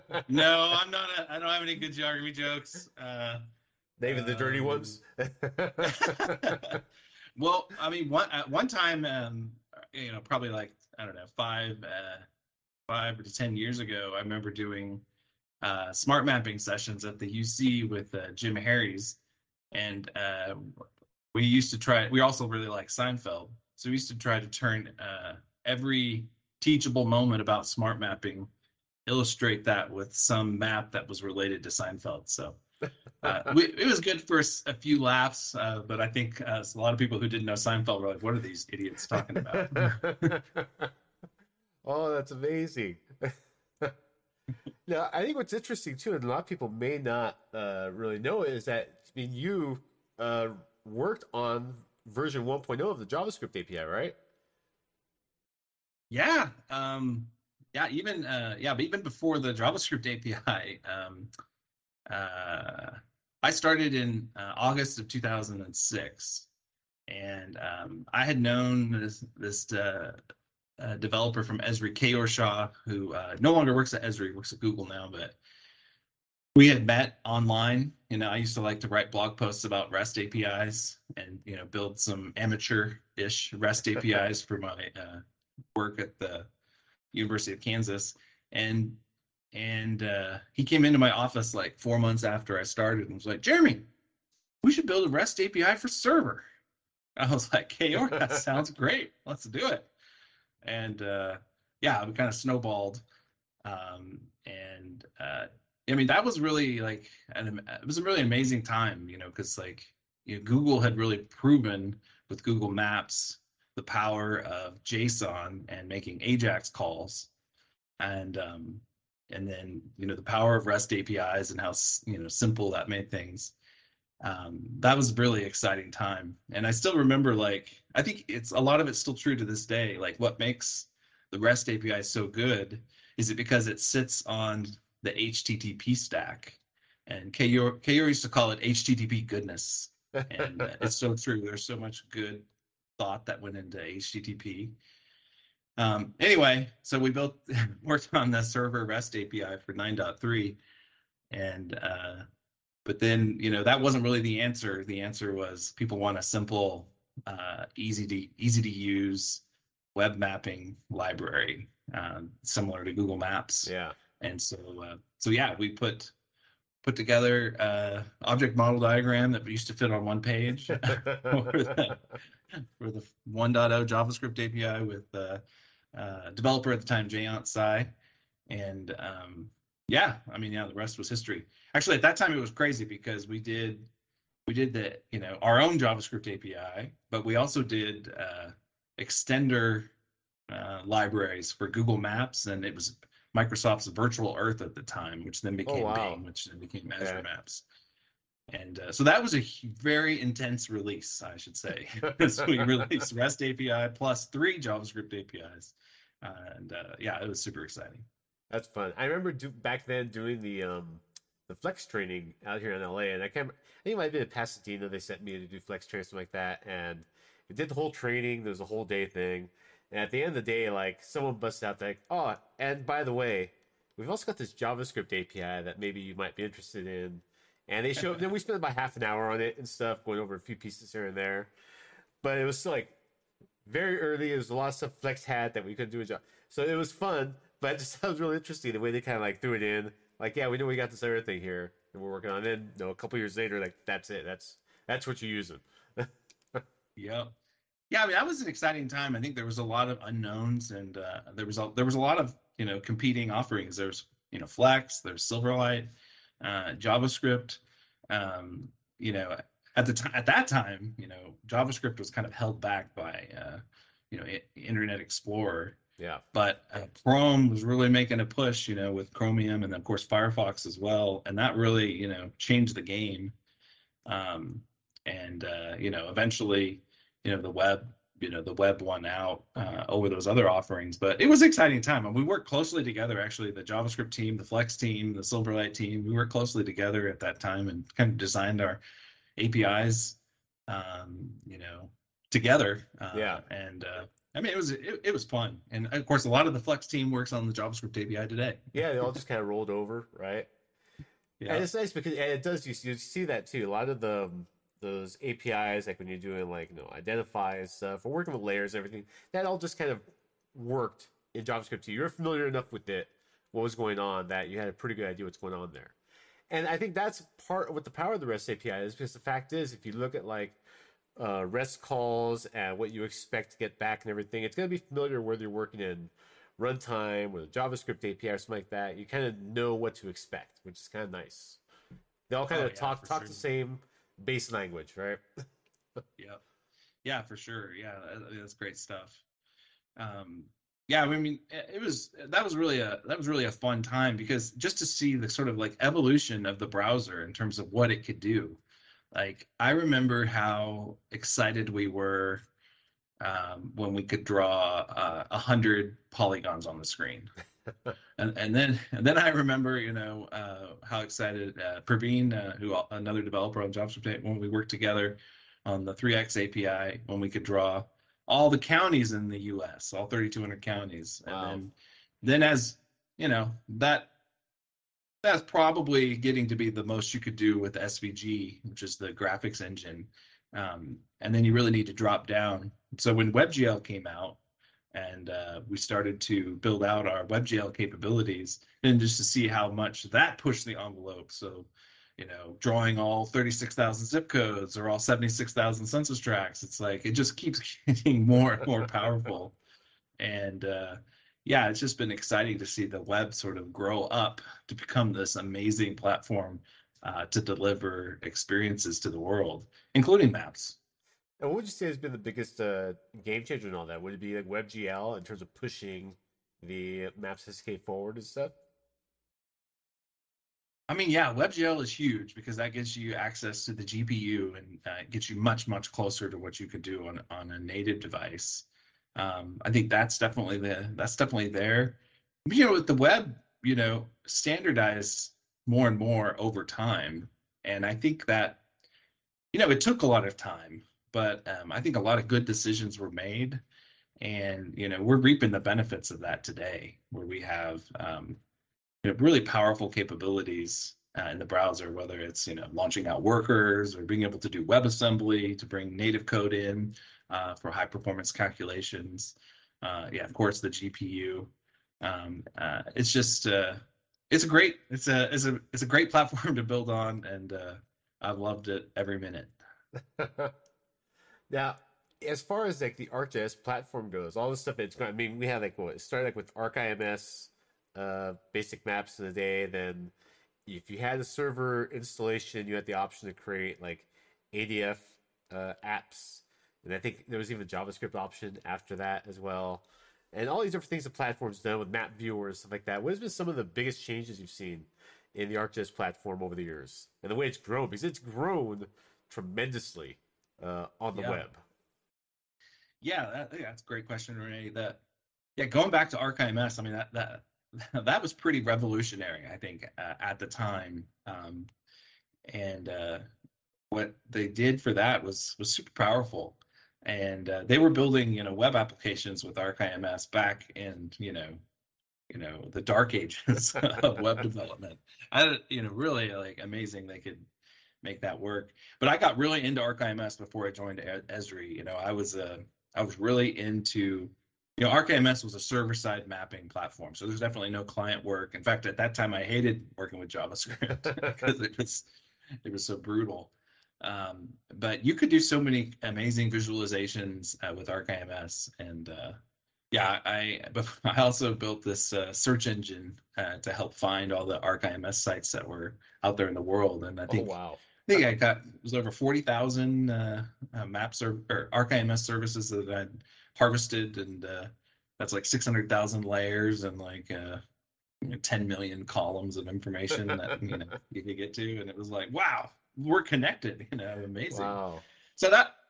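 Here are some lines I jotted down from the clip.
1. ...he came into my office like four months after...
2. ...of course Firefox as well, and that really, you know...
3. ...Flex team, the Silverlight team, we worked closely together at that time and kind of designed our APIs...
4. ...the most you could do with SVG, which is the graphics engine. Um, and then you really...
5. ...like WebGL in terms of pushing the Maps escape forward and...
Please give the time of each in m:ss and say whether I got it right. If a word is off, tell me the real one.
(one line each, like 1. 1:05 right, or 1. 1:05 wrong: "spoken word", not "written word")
1. 1:30 right
2. 4:29 right
3. 4:44 right
4. 6:16 right
5. 6:54 right.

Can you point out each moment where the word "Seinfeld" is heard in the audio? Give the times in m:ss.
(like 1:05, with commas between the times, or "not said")
0:22, 0:31, 0:37.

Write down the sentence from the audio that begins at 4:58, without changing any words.
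yeah, they all just kind of rolled over, right?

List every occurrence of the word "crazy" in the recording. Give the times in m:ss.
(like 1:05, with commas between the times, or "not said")
3:02.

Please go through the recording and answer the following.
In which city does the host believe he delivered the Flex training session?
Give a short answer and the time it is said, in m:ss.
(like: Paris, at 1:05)
Pasadena, at 3:34.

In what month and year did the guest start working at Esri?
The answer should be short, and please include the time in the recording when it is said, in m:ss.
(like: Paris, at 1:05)
August 2006, at 1:04.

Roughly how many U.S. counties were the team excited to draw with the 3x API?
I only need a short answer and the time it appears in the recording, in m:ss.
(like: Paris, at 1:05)
3,200, at 6:10.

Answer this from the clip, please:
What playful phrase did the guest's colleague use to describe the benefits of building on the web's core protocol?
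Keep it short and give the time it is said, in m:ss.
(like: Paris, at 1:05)
HTTP goodness, at 2:18.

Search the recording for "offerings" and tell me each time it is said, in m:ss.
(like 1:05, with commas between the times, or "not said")
4:13, 4:40.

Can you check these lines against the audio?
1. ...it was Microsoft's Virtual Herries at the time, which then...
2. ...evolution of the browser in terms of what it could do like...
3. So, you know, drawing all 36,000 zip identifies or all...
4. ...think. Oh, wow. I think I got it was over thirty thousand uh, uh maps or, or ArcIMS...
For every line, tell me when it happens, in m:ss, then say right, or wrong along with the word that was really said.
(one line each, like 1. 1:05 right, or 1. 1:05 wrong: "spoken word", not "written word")
1. 3:12 wrong: "Earth", not "Herries"
2. 5:45 right
3. 6:31 wrong: "codes", not "identifies"
4. 9:17 wrong: "forty", not "thirty".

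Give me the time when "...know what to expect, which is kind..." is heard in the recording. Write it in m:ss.
5:29.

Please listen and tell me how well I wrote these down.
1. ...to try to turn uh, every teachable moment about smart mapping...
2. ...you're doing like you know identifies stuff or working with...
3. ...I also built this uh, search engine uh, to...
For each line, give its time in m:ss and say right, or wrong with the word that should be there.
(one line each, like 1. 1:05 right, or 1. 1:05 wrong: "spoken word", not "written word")
1. 0:24 right
2. 5:06 right
3. 9:11 right.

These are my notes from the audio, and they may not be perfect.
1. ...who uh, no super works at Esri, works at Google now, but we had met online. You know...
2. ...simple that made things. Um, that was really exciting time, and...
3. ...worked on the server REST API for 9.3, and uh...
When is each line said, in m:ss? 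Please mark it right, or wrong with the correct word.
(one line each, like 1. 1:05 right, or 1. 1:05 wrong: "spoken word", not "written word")
1. 1:12 wrong: "longer", not "super"
2. 2:02 right
3. 2:27 right.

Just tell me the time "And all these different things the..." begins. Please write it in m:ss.
8:10.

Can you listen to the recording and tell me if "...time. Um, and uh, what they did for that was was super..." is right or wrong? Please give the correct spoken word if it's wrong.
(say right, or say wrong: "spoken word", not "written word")
right.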